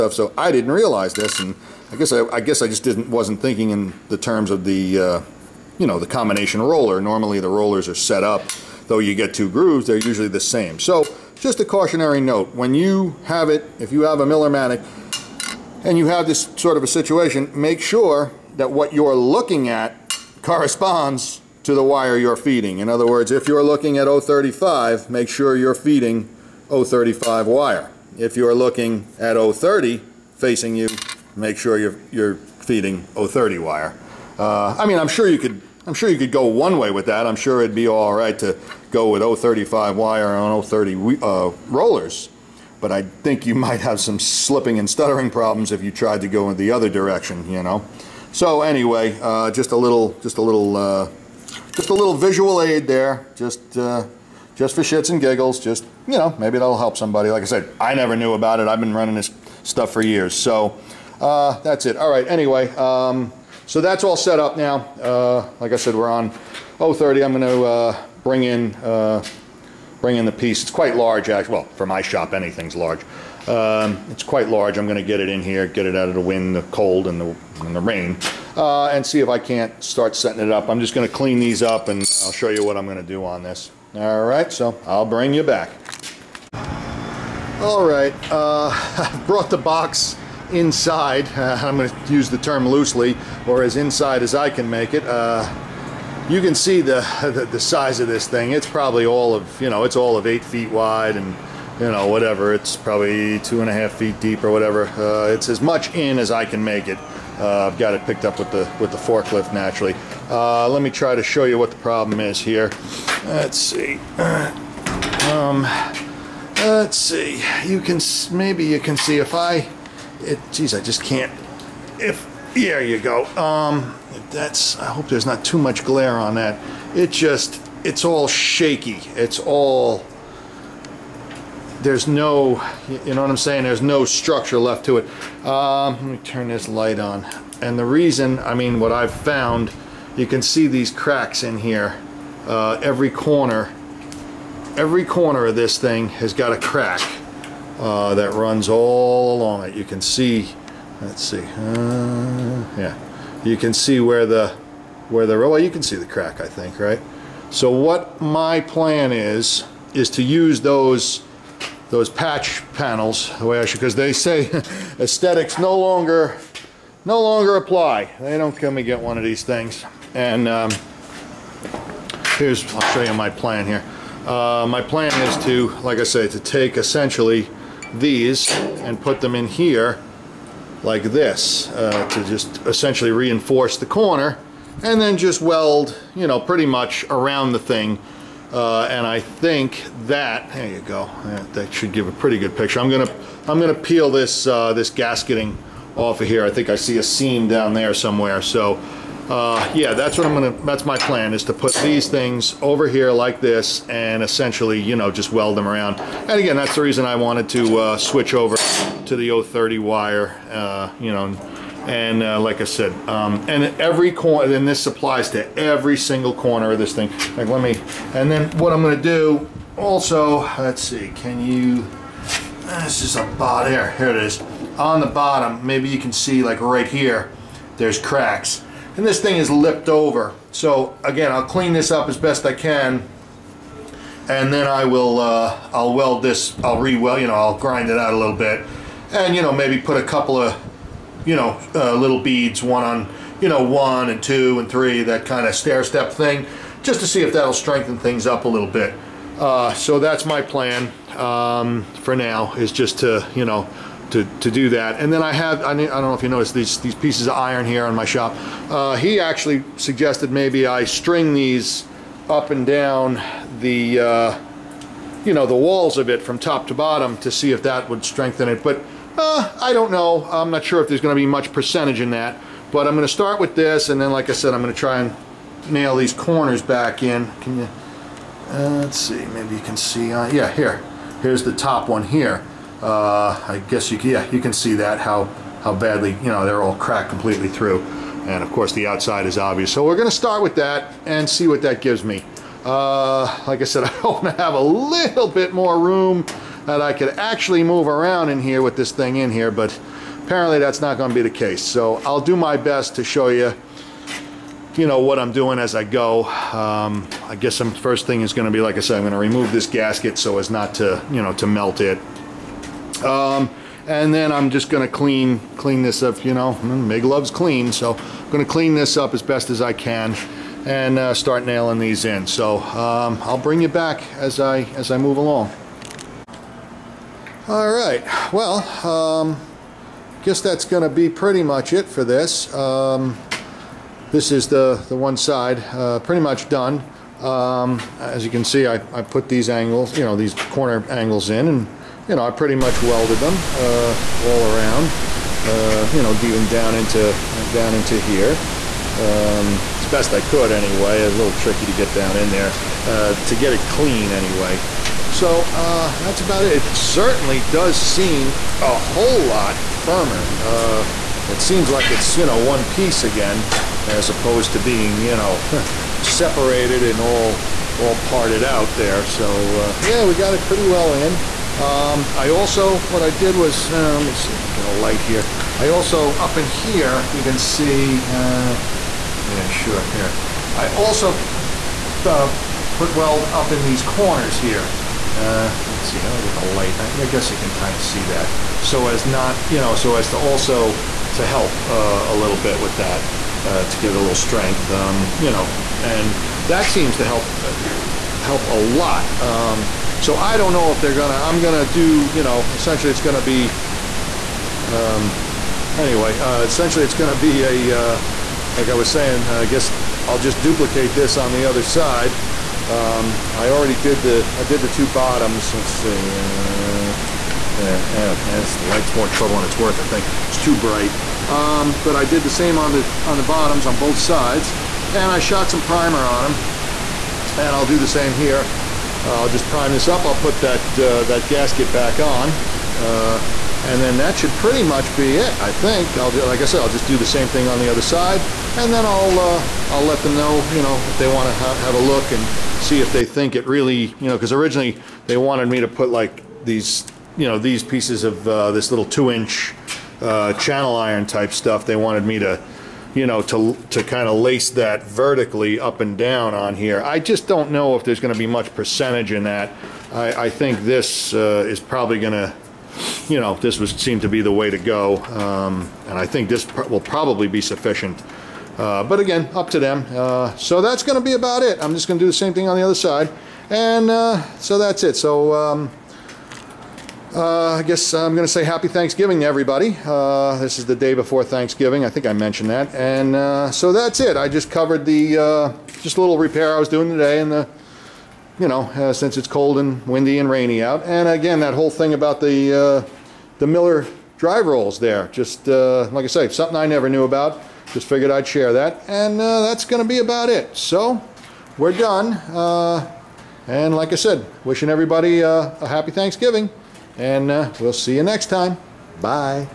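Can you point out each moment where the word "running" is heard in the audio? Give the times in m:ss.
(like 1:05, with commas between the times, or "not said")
0:58.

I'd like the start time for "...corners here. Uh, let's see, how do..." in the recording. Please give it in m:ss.
6:23.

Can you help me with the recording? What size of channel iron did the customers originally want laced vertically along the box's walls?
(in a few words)
2 inch.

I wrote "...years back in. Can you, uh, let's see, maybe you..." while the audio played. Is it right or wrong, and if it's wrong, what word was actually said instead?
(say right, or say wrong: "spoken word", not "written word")
wrong: "corners", not "years".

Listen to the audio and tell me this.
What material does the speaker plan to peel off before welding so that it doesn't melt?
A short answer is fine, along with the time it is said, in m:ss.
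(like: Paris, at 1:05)
gasketing, at 3:14.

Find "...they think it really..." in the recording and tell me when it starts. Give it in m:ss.
7:22.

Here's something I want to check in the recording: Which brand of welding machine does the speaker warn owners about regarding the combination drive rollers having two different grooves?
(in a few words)
Miller-Matic.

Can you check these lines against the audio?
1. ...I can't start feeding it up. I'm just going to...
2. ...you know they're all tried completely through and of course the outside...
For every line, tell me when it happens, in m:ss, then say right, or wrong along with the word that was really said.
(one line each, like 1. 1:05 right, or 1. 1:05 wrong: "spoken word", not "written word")
1. 1:19 wrong: "setting", not "feeding"
2. 4:46 wrong: "cracked", not "tried".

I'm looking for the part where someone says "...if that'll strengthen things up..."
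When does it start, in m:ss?
4:07.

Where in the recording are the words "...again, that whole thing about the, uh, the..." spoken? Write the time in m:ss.
8:11.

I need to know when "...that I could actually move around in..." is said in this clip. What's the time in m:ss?
4:56.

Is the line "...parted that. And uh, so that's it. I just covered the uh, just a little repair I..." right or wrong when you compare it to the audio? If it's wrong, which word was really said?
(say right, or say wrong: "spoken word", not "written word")
wrong: "mentioned", not "parted".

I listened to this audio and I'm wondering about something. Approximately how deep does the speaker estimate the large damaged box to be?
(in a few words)
2.5 feet.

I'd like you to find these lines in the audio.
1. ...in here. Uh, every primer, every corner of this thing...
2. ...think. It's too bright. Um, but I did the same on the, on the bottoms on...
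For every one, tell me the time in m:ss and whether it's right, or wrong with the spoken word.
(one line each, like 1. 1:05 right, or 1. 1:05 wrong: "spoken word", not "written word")
1. 2:21 wrong: "corner", not "primer"
2. 6:59 right.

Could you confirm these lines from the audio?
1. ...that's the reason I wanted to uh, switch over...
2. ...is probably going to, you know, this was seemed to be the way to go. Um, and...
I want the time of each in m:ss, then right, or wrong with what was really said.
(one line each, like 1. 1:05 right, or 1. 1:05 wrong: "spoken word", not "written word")
1. 3:26 right
2. 7:41 right.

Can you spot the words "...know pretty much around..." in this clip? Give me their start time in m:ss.
3:06.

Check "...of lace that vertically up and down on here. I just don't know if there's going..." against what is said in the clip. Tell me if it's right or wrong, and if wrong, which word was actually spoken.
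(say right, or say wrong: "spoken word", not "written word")
right.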